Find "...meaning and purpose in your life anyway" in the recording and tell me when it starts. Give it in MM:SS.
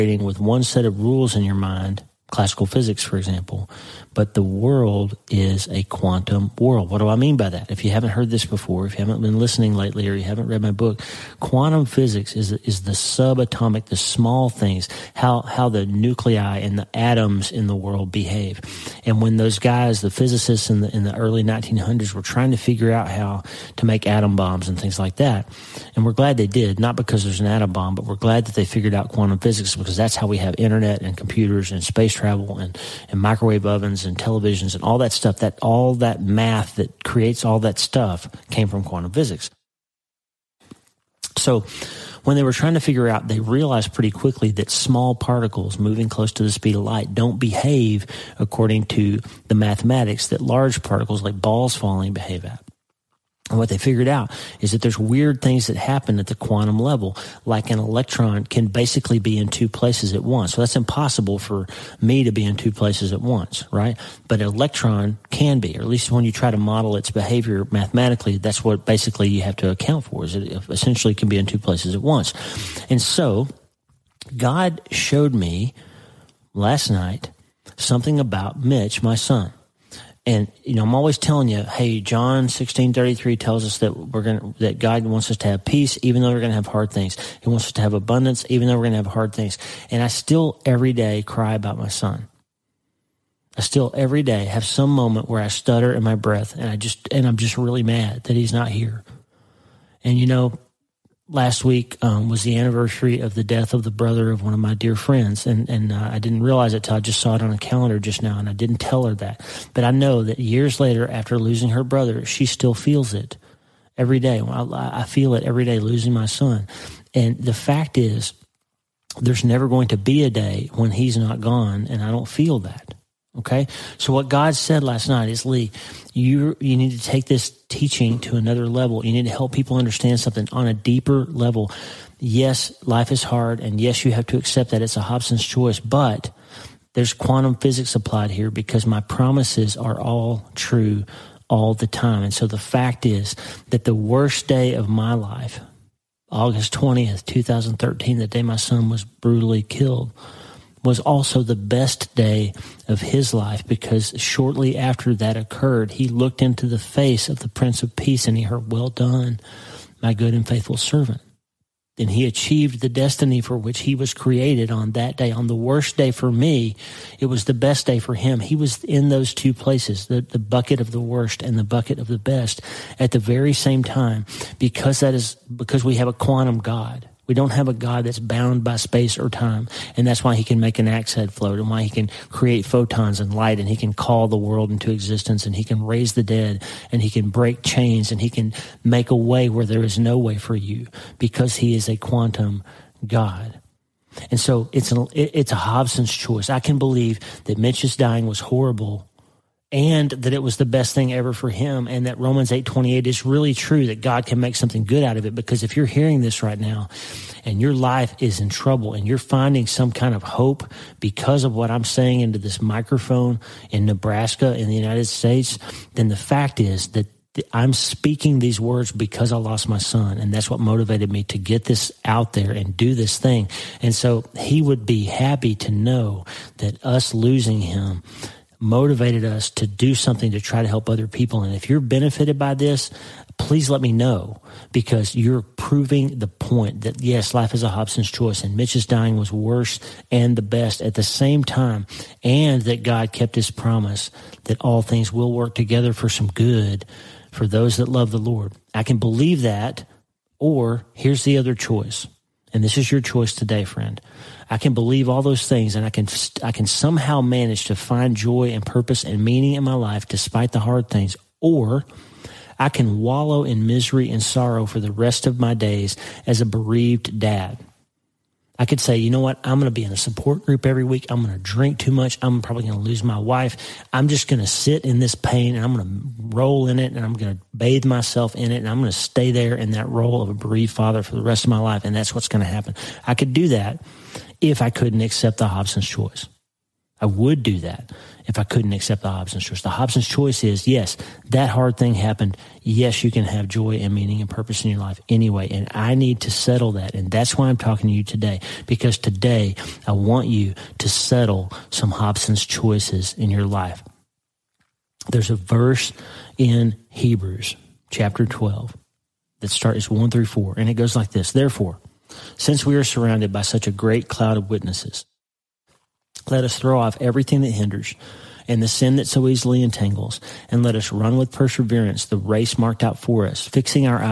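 04:53.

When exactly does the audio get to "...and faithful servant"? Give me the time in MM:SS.
02:40.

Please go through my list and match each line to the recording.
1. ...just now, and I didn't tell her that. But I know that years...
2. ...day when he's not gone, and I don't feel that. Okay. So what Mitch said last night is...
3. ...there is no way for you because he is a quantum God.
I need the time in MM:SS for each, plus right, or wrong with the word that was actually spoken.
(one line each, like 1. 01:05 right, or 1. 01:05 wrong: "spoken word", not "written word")
1. 01:47 right
2. 02:00 wrong: "God", not "Mitch"
3. 03:09 right.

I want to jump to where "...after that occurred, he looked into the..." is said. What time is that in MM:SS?
02:34.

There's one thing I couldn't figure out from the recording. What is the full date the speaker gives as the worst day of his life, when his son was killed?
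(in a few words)
August 20th, 2013.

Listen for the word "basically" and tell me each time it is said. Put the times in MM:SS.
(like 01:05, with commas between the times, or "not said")
00:58, 01:08.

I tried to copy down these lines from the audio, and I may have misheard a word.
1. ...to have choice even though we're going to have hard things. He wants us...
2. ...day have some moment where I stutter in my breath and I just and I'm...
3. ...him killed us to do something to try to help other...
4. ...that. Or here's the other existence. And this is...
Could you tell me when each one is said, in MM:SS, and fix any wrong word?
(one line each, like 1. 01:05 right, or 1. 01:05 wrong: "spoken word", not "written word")
1. 01:25 wrong: "peace", not "choice"
2. 01:34 right
3. 03:47 wrong: "motivated", not "killed"
4. 04:09 wrong: "choice", not "existence".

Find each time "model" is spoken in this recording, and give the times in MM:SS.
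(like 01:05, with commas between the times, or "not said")
01:06.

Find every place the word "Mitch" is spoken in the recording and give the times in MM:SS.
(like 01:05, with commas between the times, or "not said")
01:18, 03:17, 03:58.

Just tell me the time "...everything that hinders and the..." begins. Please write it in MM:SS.
05:16.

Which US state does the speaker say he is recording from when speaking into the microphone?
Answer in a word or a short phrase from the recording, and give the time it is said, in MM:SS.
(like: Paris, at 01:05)
Nebraska, at 03:33.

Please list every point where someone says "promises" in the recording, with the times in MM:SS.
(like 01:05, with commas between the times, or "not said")
02:18, 04:03.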